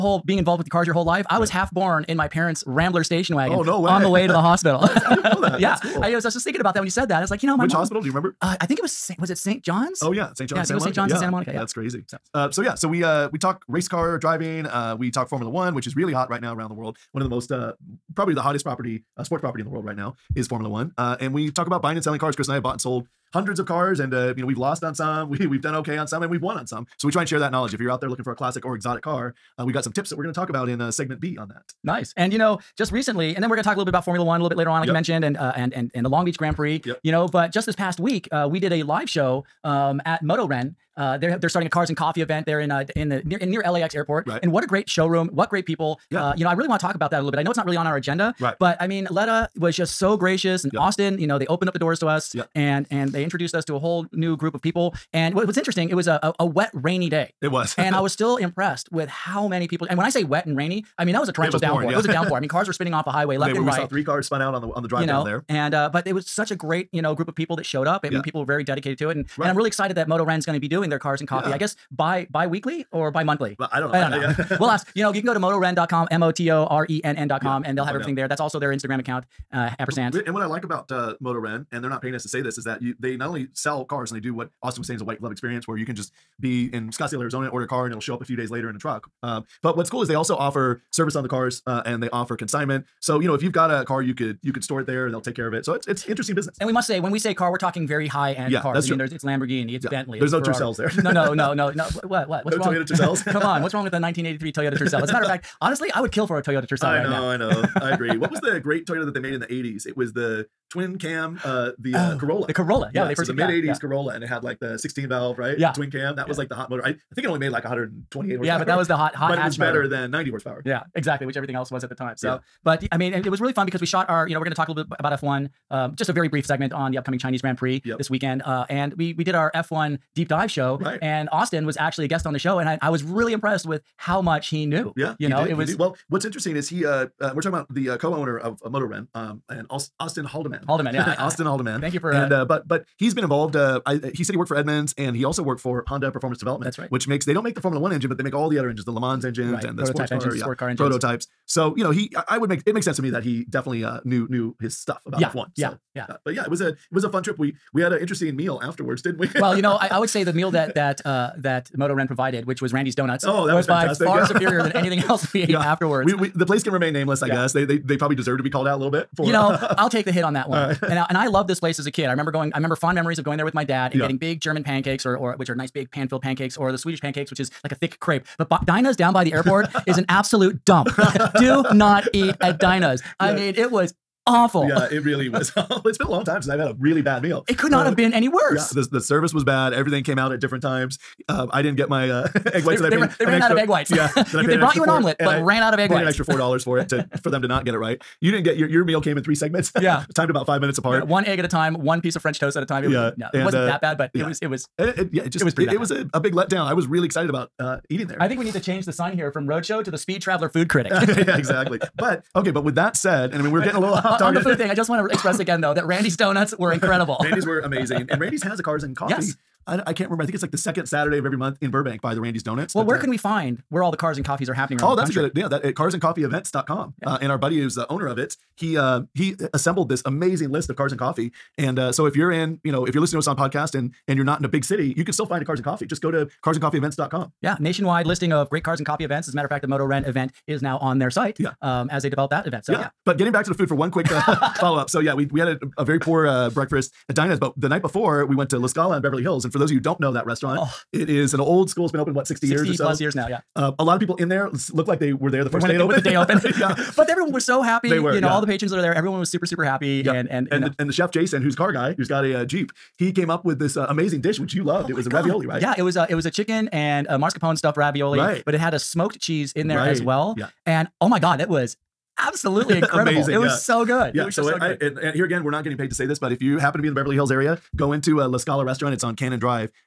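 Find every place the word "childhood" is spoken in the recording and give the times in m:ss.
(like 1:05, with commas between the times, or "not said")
not said.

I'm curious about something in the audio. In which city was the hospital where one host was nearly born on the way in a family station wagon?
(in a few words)
Santa Monica.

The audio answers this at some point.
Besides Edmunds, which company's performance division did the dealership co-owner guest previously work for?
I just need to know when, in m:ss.
2:25.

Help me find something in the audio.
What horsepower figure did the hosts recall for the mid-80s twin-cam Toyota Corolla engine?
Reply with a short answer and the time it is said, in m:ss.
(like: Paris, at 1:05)
128, at 1:57.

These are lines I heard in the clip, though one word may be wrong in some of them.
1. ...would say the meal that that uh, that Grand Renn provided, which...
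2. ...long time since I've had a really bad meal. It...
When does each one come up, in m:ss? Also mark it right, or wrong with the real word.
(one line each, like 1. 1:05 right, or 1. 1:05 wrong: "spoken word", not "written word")
1. 2:39 wrong: "Moto", not "Grand"
2. 3:06 right.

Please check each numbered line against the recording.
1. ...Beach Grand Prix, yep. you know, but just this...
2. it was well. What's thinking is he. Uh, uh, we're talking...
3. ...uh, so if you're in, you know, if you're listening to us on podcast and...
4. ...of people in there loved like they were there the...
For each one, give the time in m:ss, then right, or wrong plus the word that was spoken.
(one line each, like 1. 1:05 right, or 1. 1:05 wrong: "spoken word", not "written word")
1. 0:36 right
2. 2:15 wrong: "interesting", not "thinking"
3. 3:51 right
4. 4:13 wrong: "looked", not "loved".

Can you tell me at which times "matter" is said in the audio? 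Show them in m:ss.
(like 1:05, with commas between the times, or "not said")
1:45, 3:59.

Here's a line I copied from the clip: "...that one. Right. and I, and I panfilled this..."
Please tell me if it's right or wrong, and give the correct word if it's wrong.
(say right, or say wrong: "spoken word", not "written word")
wrong: "loved", not "panfilled".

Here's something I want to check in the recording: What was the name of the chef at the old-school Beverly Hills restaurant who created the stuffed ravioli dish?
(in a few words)
Jason.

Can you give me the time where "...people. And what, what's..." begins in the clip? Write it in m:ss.
0:54.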